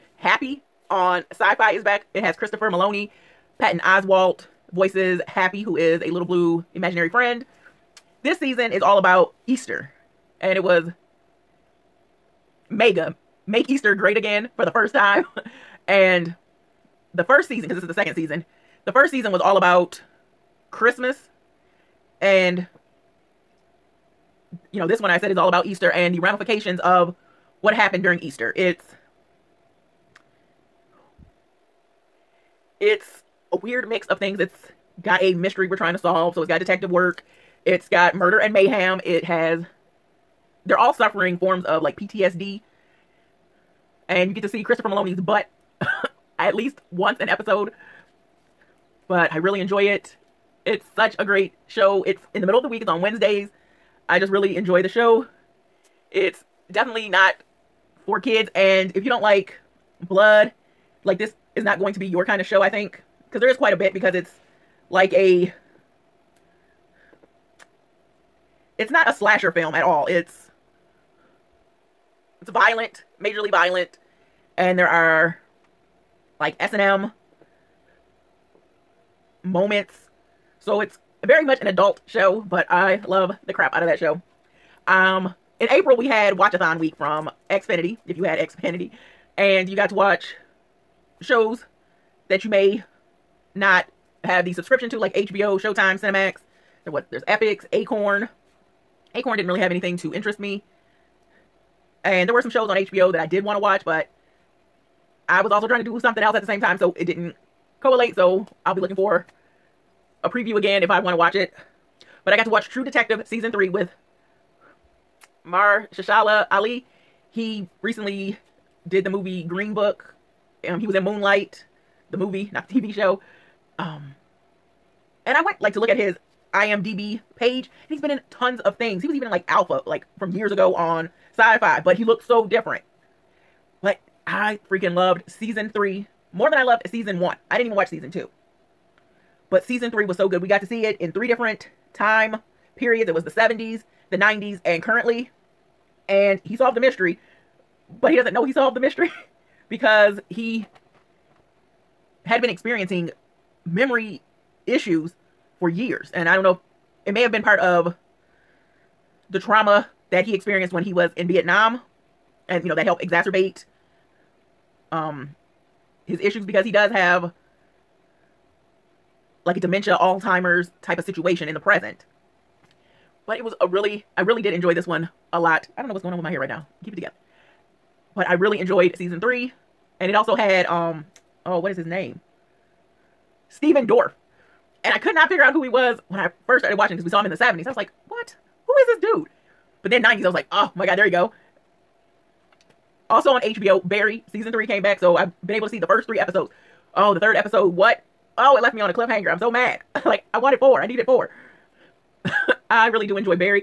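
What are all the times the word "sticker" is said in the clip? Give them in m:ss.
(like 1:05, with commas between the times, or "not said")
not said.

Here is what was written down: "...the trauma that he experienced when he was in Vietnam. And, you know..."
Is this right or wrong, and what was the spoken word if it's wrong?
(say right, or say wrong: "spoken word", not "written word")
right.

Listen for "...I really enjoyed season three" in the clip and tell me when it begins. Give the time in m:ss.
2:58.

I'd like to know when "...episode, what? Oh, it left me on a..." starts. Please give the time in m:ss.
3:17.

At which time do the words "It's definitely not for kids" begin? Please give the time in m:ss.
0:56.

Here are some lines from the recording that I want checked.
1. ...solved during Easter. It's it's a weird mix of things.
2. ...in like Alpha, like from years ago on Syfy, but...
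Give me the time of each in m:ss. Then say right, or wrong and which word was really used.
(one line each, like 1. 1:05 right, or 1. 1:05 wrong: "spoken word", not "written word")
1. 0:27 wrong: "happened", not "solved"
2. 2:09 right.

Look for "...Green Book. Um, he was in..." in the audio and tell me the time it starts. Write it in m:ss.
1:59.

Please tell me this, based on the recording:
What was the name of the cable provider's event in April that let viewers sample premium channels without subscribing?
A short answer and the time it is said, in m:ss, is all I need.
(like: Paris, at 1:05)
Watchathon week, at 1:26.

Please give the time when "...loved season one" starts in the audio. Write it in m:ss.
2:16.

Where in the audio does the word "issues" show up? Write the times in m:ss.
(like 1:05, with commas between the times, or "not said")
2:34, 2:46.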